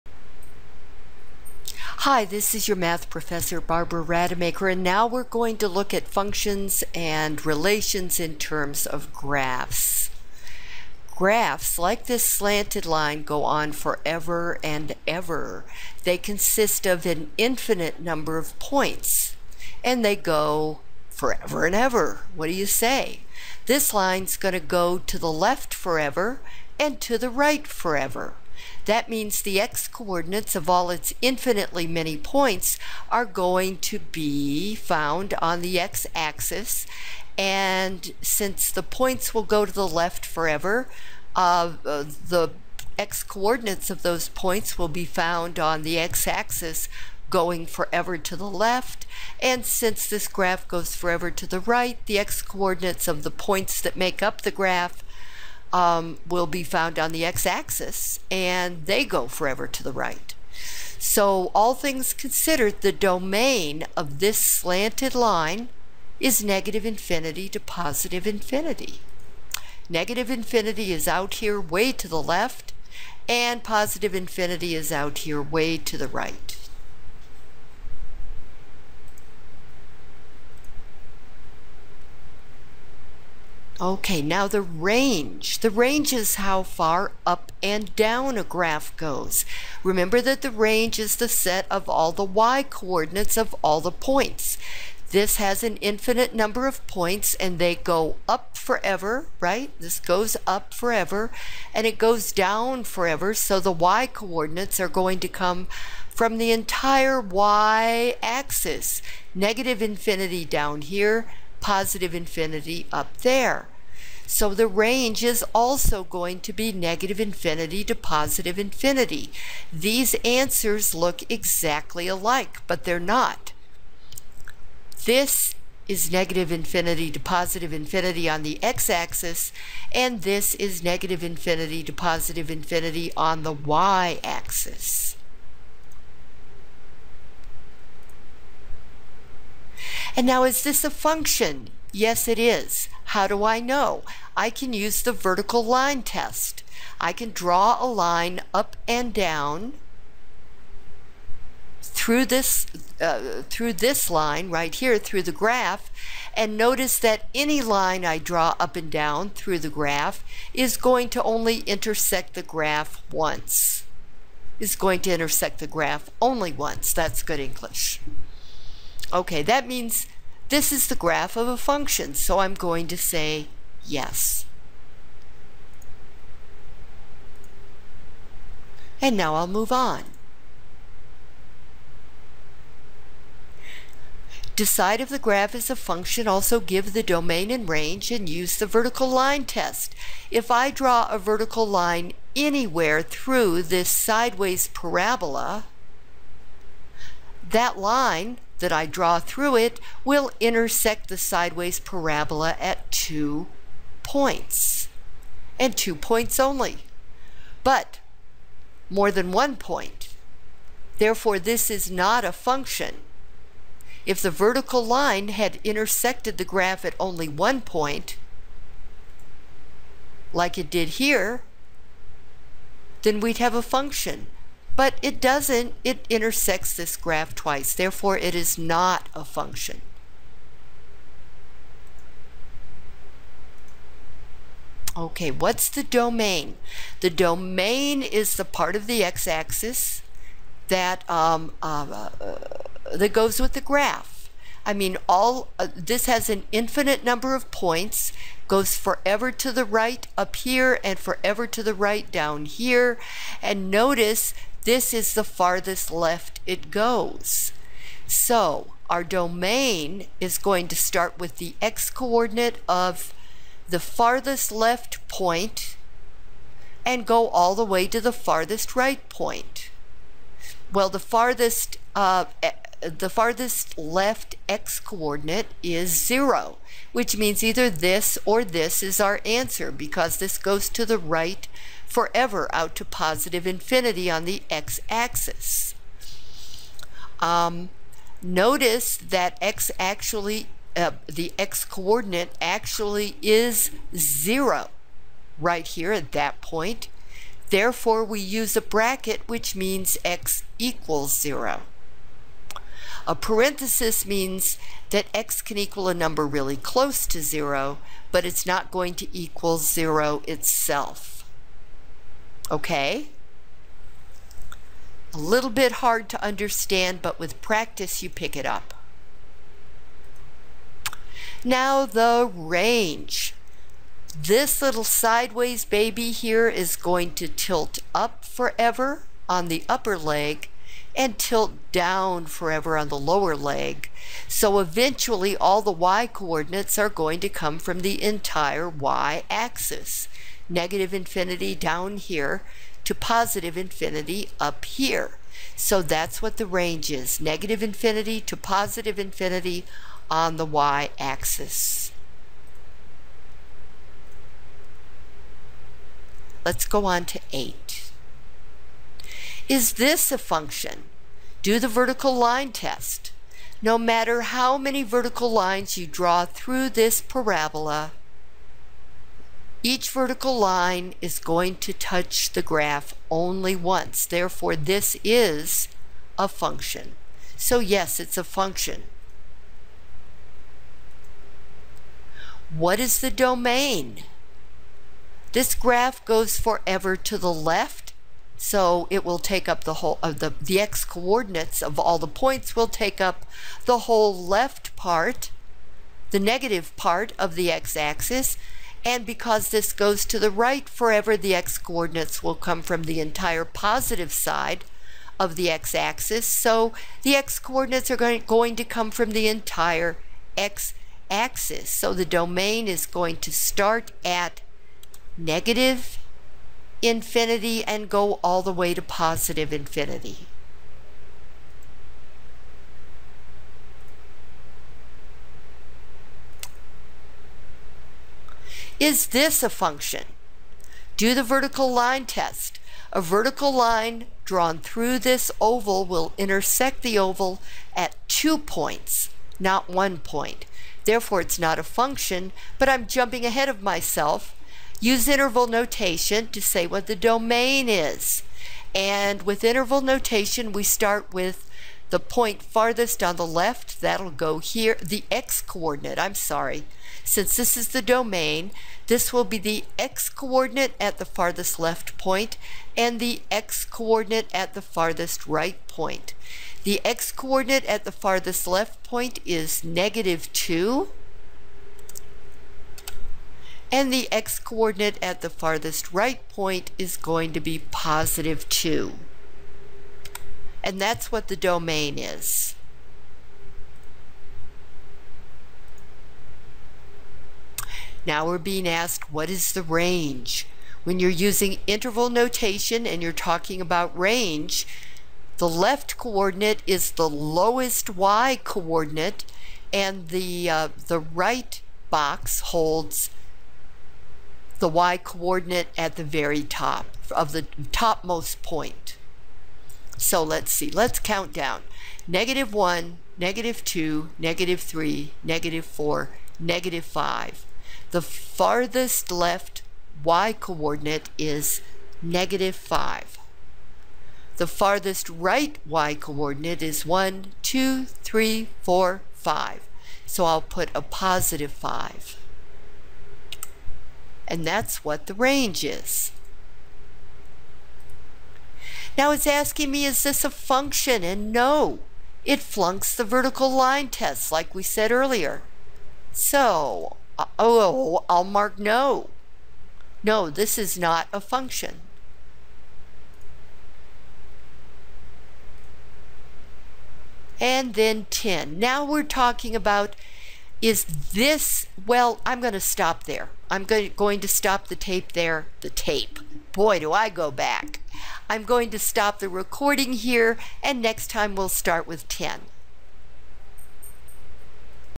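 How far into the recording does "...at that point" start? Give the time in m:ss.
4:55.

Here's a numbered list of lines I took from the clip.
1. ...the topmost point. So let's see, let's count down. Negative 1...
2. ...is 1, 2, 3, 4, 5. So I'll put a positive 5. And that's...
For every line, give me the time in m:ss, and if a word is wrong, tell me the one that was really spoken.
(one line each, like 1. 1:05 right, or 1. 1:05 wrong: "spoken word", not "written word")
1. 8:27 right
2. 8:46 right.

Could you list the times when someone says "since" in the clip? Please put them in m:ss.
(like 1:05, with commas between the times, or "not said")
0:38, 0:49, 7:37.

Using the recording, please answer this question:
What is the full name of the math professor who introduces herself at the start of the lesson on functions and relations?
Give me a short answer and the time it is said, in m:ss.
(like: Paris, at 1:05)
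Barbara Rademacher, at 0:03.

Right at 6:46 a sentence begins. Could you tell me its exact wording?
So the x coordinates are going, to come from the entire x-axis.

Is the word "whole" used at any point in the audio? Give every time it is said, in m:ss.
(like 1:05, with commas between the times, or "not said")
6:29, 6:33.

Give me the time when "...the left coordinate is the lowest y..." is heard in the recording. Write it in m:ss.
8:15.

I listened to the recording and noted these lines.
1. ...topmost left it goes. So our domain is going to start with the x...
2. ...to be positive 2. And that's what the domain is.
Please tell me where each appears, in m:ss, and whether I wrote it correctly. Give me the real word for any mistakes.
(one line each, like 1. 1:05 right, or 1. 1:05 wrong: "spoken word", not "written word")
1. 4:15 wrong: "farthest", not "topmost"
2. 7:57 right.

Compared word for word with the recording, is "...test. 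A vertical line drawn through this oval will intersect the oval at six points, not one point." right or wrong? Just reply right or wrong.
wrong.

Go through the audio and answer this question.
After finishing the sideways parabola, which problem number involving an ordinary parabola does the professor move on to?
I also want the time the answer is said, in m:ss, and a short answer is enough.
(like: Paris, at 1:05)
8, at 5:57.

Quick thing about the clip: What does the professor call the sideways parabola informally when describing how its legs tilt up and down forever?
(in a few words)
little sideways baby.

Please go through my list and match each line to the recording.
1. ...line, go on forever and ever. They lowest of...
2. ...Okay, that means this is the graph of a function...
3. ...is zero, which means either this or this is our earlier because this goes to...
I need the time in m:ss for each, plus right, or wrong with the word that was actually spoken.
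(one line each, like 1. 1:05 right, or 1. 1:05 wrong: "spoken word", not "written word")
1. 0:12 wrong: "consist", not "lowest"
2. 2:49 right
3. 4:35 wrong: "answer", not "earlier".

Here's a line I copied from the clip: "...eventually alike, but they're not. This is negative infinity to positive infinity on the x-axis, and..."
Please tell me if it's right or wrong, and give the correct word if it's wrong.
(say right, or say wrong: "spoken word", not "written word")
wrong: "exactly", not "eventually".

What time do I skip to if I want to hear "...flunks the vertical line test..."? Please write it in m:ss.
9:02.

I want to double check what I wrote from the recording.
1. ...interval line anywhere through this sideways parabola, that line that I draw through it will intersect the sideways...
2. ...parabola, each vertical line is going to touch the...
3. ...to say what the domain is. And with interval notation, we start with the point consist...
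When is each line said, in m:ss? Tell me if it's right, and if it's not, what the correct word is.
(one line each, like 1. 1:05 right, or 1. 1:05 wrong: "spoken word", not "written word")
1. 3:11 wrong: "vertical", not "interval"
2. 6:07 right
3. 7:26 wrong: "farthest", not "consist".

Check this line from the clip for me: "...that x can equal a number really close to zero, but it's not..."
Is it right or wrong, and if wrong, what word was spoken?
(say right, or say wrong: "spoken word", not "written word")
right.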